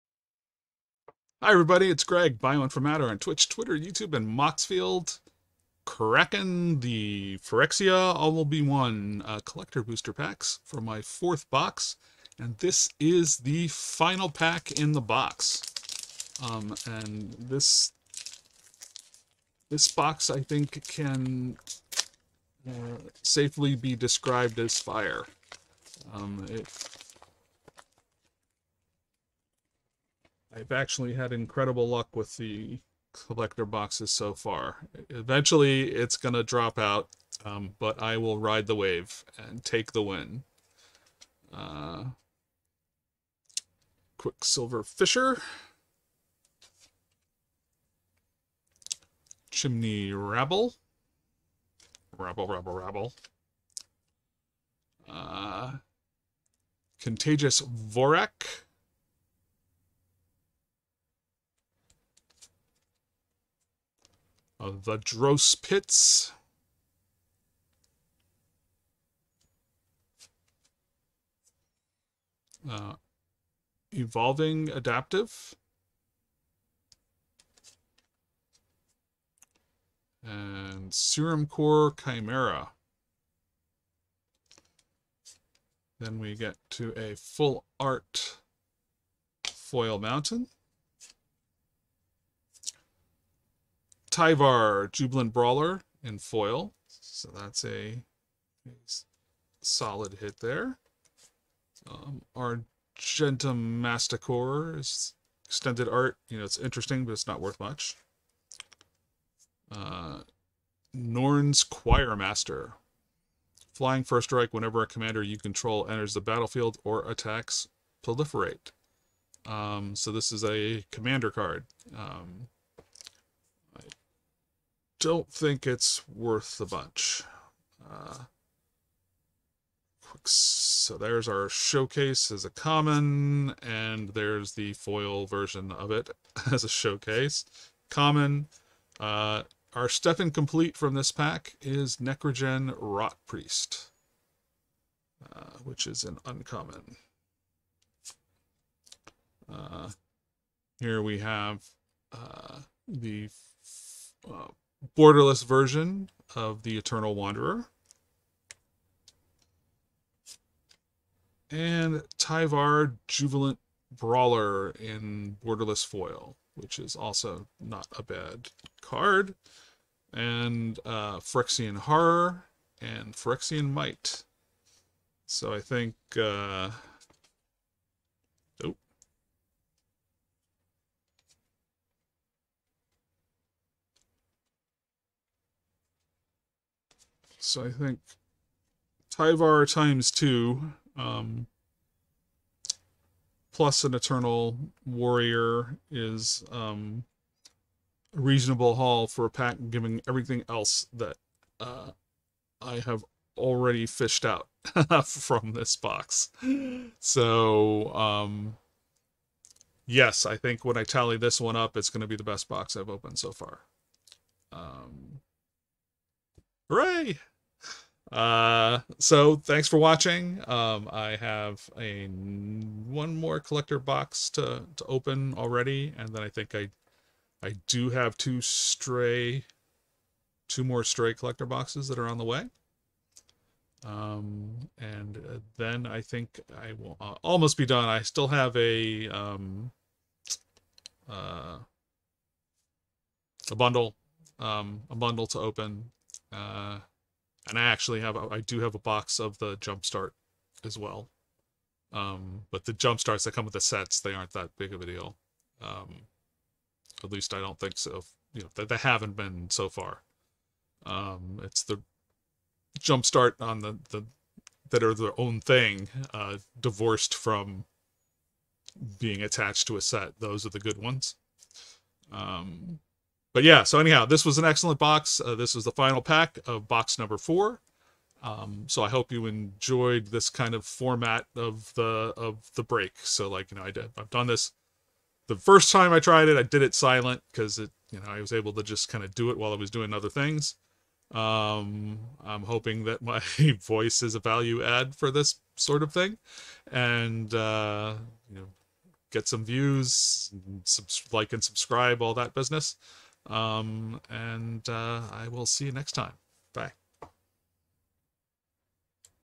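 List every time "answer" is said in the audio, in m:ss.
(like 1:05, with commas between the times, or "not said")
not said.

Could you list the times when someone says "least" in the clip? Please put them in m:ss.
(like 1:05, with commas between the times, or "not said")
4:17.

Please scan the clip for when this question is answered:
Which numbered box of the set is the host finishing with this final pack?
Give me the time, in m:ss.
0:11.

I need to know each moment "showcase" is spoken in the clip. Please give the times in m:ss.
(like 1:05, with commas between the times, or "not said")
2:11, 2:16.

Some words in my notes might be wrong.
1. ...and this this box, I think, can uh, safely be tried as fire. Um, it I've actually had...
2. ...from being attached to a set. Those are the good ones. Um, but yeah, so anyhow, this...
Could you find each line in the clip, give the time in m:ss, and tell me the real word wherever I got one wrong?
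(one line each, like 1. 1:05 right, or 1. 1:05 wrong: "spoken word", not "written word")
1. 0:16 wrong: "described", not "tried"
2. 4:27 right.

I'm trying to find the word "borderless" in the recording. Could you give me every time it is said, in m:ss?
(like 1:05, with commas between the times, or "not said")
2:34, 2:45.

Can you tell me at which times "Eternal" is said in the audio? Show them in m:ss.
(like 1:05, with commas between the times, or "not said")
2:36, 3:13.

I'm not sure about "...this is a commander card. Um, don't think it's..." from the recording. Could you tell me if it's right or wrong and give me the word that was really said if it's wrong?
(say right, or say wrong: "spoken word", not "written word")
right.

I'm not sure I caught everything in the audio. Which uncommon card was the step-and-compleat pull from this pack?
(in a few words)
Necrogen Rot Priest.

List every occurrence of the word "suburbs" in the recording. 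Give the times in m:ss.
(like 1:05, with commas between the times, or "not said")
not said.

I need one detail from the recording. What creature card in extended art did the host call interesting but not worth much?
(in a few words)
Argentum Masticore.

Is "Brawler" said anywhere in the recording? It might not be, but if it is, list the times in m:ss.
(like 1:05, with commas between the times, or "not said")
1:35, 2:43.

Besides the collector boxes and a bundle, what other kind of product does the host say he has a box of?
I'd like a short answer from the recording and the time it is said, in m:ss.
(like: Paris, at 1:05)
Jumpstart, at 4:09.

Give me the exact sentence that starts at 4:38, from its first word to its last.
Um, so I hope you enjoyed this kind of format of the of the break.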